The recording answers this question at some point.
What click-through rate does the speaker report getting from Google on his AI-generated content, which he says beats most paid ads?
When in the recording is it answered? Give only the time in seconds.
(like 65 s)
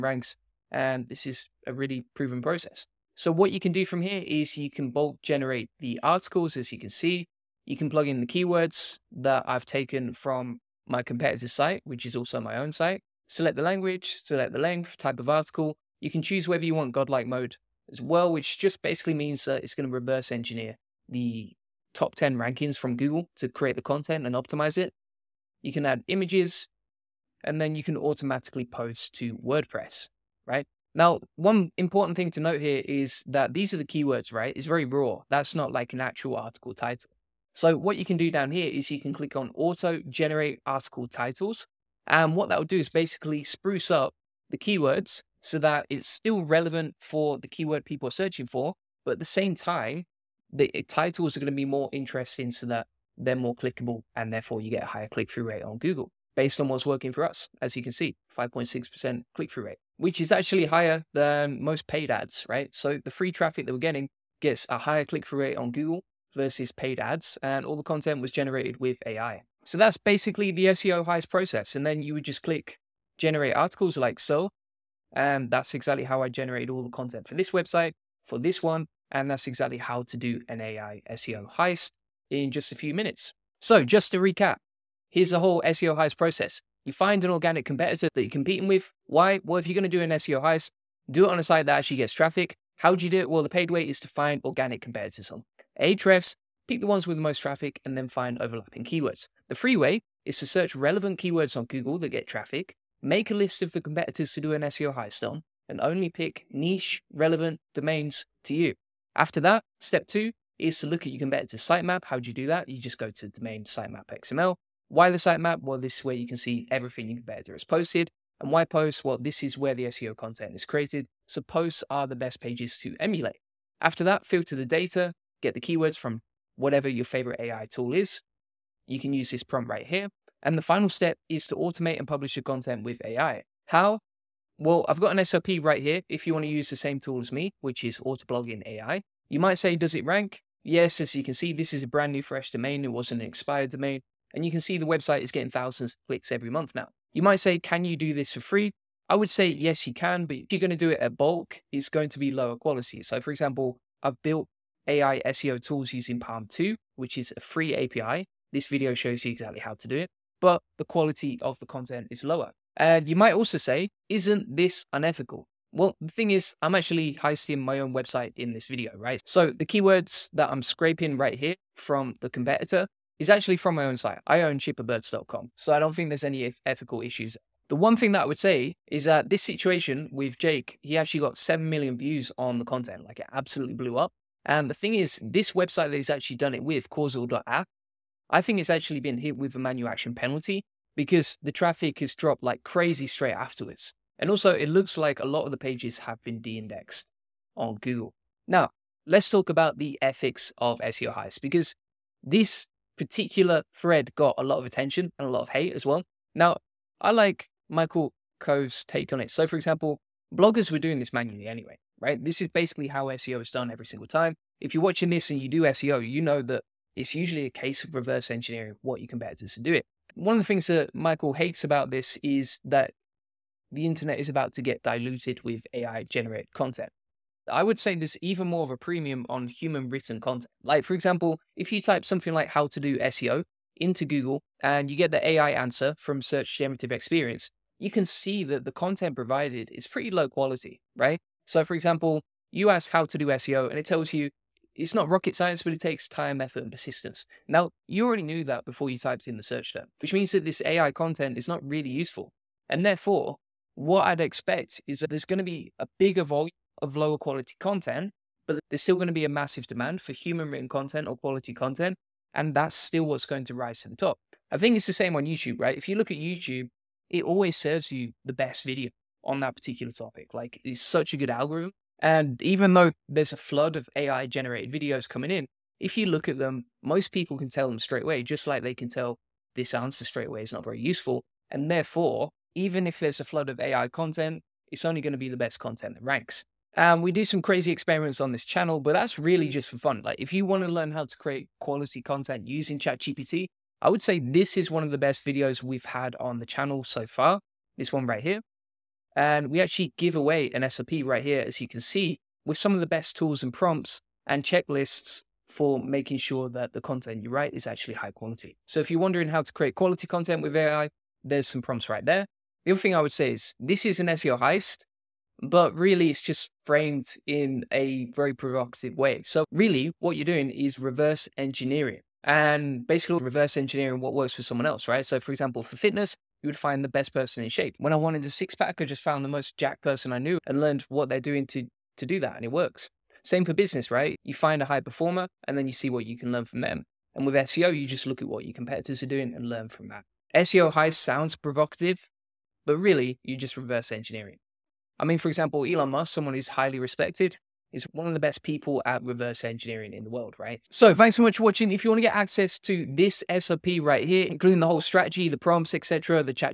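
58 s.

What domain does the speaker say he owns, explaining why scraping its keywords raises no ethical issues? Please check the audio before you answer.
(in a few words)
cheaperbirds.com.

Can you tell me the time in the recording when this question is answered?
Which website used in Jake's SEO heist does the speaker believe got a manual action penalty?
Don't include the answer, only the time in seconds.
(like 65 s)
186 s.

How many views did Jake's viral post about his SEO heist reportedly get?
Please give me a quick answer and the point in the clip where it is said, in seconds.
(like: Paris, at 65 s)
7 million, at 181 s.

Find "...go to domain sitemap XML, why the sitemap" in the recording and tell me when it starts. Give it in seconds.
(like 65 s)
112 s.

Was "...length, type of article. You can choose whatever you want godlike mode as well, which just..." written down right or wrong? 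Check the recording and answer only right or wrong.
wrong.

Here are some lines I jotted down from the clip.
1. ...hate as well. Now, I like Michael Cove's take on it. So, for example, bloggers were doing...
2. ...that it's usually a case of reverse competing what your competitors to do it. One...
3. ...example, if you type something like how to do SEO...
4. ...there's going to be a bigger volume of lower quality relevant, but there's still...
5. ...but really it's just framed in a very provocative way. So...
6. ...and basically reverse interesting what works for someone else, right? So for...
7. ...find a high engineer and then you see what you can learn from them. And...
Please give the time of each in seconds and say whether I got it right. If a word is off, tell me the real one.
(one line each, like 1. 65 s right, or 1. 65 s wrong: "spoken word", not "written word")
1. 205 s right
2. 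216 s wrong: "engineering", not "competing"
3. 230 s right
4. 255 s wrong: "content", not "relevant"
5. 315 s right
6. 322 s wrong: "engineering", not "interesting"
7. 334 s wrong: "performer", not "engineer".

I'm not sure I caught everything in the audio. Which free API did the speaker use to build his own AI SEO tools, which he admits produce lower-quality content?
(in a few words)
PaLM 2.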